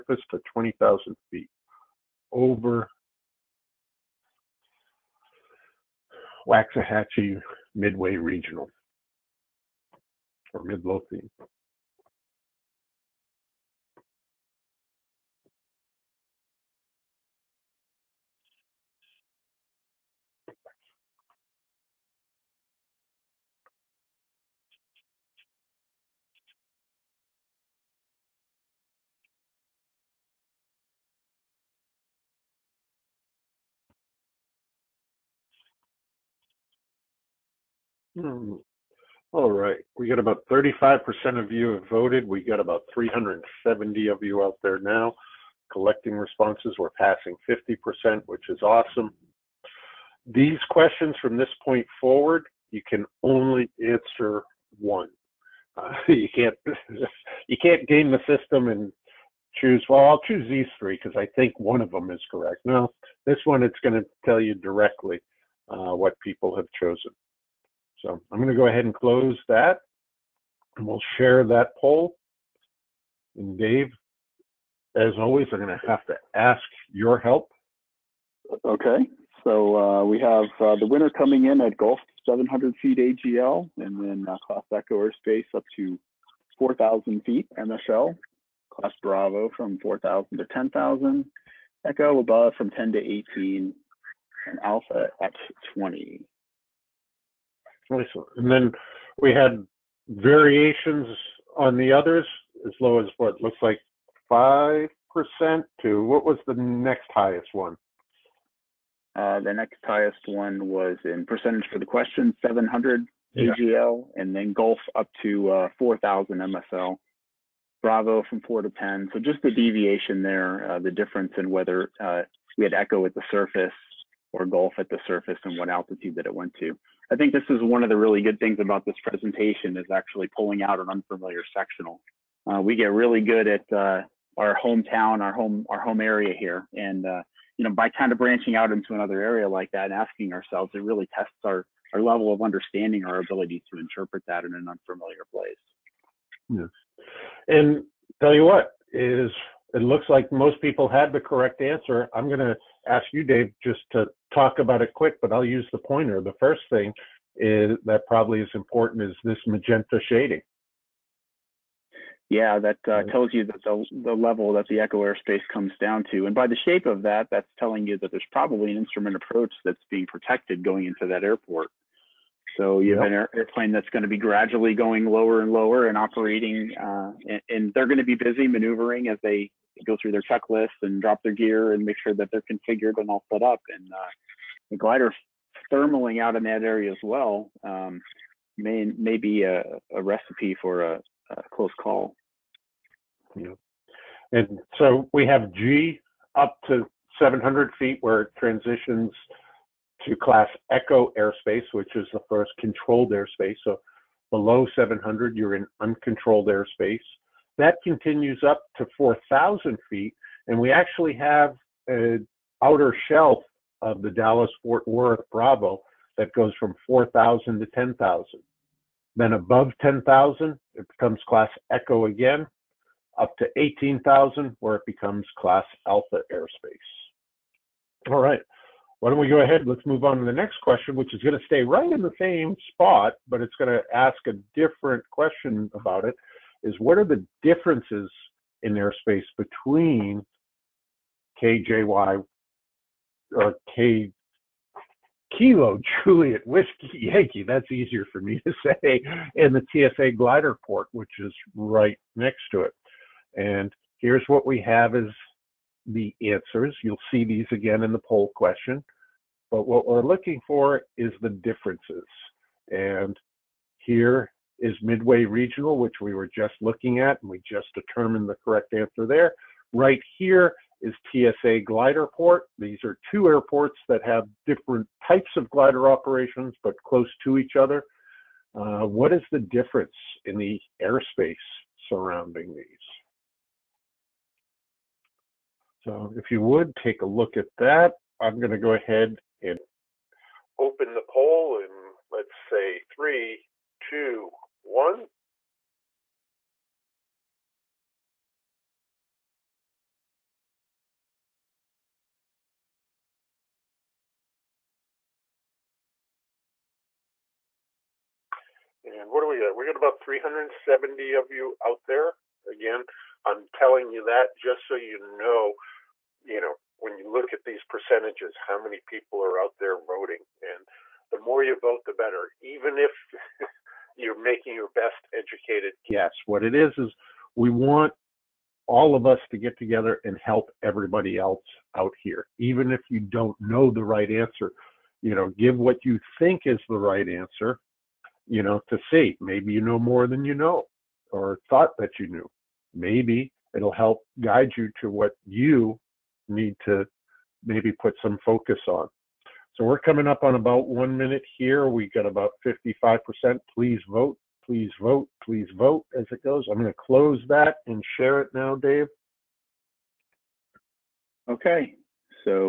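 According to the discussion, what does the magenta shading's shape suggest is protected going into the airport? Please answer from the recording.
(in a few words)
an instrument approach.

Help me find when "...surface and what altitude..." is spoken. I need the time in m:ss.
2:05.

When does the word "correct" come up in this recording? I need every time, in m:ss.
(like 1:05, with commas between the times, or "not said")
1:02, 2:31, 4:28.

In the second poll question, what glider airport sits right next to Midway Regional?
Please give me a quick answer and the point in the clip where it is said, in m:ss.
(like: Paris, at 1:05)
TSA Gliderport, at 4:31.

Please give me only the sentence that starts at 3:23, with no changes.
So below 700, you're in uncontrolled airspace.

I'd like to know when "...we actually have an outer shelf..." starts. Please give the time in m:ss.
3:30.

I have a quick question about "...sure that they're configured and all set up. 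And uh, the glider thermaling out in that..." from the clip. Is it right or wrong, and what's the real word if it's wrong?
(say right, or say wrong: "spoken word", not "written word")
right.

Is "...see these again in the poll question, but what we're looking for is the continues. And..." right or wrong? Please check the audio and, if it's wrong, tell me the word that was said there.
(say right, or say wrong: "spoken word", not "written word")
wrong: "differences", not "continues".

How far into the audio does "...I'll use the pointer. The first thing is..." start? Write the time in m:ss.
2:35.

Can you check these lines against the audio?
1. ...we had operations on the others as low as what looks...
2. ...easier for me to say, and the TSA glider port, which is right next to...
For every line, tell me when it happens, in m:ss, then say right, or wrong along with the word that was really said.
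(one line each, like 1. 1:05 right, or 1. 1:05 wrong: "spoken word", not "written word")
1. 1:39 wrong: "variations", not "operations"
2. 4:07 right.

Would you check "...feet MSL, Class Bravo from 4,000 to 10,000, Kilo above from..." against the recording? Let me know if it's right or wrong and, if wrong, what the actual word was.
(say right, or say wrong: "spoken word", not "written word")
wrong: "Echo", not "Kilo".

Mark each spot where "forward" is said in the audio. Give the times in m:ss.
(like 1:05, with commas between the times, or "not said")
0:51.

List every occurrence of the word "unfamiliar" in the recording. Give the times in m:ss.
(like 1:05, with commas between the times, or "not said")
2:10, 2:24.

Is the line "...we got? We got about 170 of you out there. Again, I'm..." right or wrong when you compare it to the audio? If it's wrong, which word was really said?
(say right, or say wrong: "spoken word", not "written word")
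wrong: "370", not "170".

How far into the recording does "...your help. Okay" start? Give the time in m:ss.
1:16.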